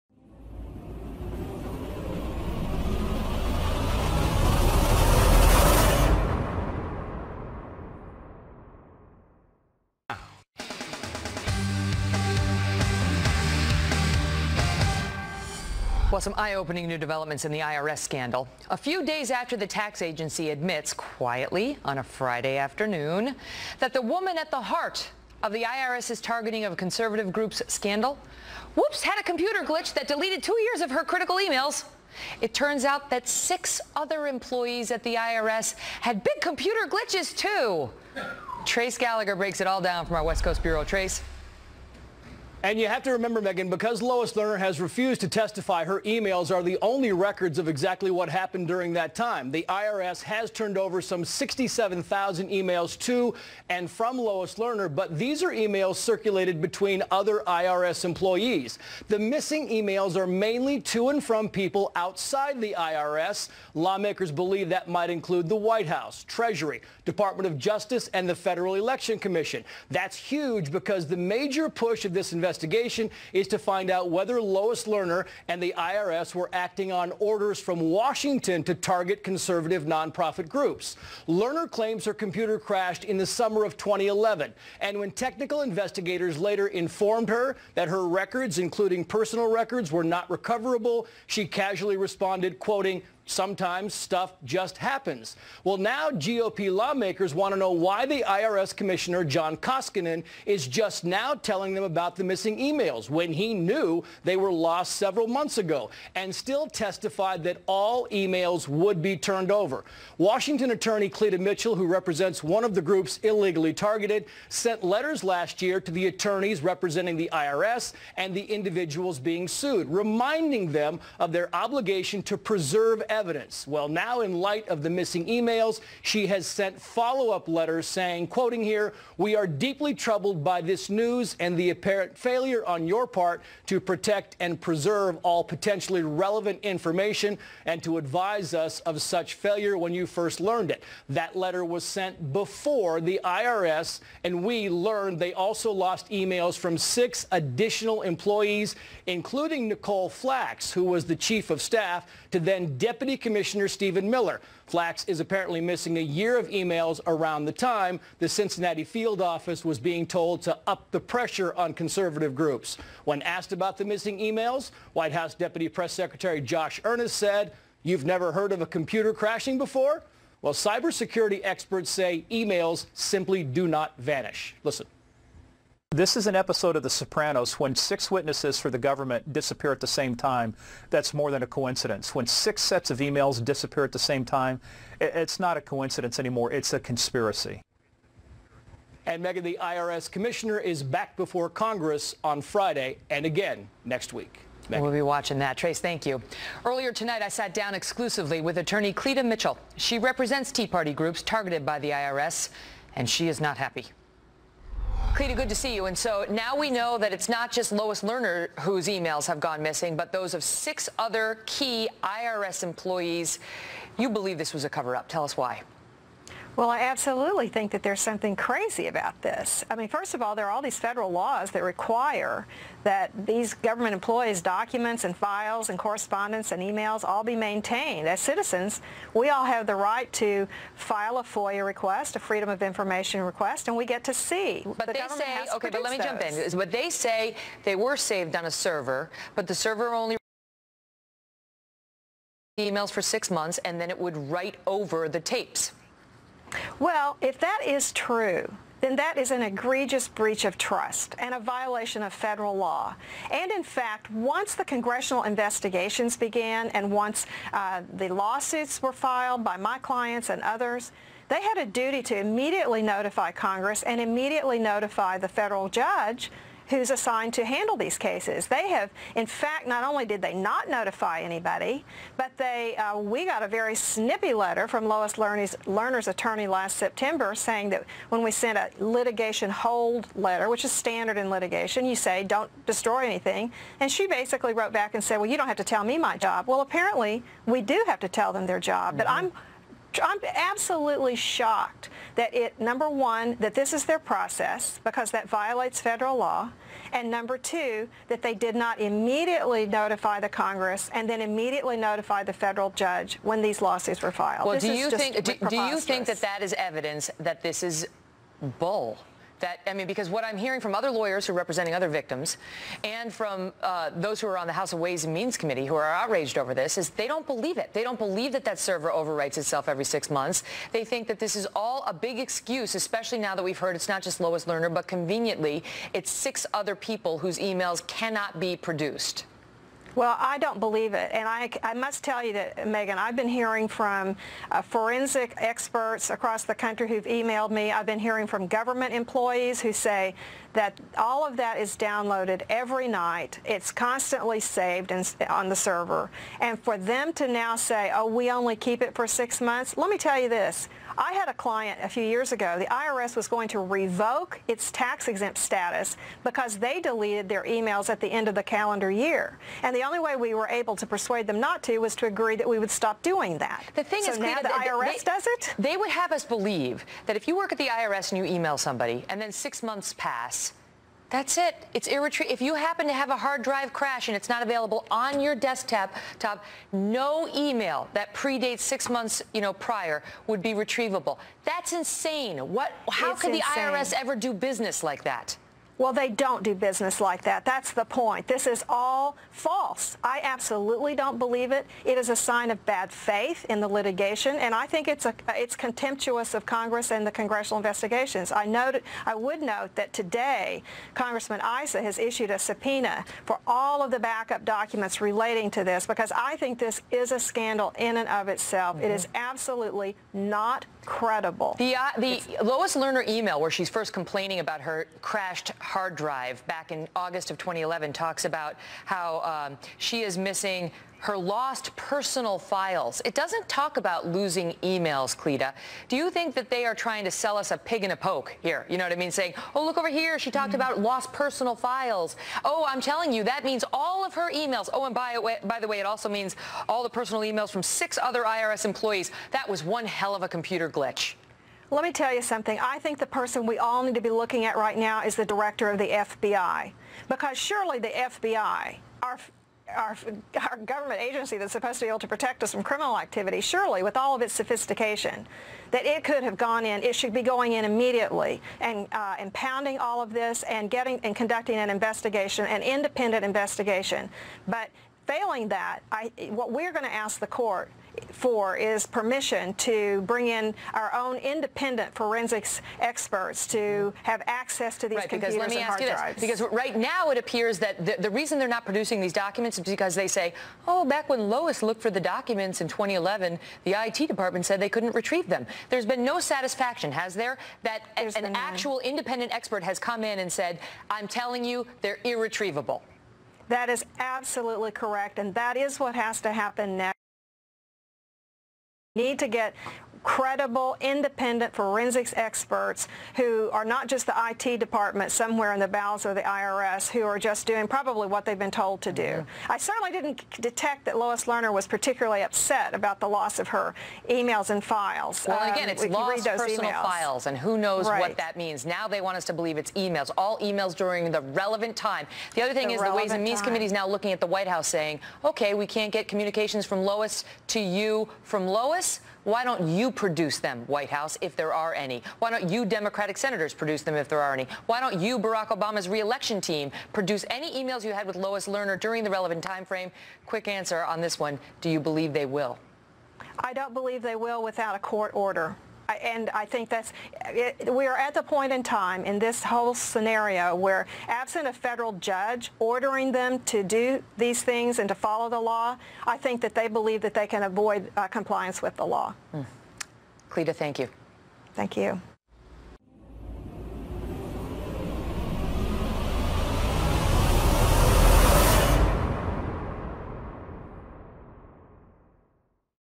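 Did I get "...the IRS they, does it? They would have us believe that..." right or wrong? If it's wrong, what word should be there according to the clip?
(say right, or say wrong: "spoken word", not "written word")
right.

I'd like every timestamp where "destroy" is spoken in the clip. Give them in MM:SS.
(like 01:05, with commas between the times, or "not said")
04:42.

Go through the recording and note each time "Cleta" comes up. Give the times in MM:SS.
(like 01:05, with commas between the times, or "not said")
01:51, 03:18, 03:25, 06:04, 07:05, 09:20.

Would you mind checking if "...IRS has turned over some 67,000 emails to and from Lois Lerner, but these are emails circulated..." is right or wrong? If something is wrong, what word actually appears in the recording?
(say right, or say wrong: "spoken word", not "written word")
right.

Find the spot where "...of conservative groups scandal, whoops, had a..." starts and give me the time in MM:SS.
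00:26.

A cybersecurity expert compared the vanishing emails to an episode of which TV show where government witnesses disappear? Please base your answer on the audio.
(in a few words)
The Sopranos.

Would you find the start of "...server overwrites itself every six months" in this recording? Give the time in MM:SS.
05:18.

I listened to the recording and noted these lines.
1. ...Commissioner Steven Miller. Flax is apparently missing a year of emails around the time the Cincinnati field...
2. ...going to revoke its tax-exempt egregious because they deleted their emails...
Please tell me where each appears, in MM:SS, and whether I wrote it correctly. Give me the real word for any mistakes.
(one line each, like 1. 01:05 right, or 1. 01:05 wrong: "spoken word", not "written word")
1. 02:33 right
2. 05:53 wrong: "status", not "egregious".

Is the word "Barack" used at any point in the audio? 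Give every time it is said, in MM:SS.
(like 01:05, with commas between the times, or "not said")
08:55.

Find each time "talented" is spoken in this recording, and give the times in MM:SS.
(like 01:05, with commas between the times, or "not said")
not said.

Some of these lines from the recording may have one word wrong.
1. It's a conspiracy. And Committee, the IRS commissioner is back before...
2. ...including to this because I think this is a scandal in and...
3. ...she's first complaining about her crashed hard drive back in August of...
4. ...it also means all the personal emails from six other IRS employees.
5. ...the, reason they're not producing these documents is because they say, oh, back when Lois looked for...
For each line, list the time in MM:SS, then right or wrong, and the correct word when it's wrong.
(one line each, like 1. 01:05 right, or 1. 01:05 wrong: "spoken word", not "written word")
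1. 03:06 wrong: "Megyn", not "Committee"
2. 06:45 wrong: "relating", not "including"
3. 06:53 right
4. 07:15 right
5. 07:57 right.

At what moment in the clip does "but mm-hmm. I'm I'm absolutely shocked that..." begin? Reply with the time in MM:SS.
04:48.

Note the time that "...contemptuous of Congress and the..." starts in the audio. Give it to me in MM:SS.
06:35.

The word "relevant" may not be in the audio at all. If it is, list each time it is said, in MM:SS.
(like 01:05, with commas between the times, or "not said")
02:16, 08:41, 08:59.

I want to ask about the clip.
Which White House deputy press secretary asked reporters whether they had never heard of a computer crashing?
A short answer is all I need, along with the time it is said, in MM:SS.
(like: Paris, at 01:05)
Josh Earnest, at 02:46.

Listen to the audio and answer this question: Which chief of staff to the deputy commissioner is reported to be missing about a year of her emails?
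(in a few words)
Nicole Flax.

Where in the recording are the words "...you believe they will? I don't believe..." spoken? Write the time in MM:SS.
09:01.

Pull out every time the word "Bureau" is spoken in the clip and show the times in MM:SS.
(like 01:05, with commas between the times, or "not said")
00:40.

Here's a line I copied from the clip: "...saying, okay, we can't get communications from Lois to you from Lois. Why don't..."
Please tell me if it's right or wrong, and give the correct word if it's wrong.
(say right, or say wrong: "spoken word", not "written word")
right.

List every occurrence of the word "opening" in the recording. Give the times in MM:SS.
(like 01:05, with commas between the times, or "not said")
00:16.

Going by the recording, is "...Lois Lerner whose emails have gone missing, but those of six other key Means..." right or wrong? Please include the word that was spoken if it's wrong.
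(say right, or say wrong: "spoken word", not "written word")
wrong: "IRS", not "Means".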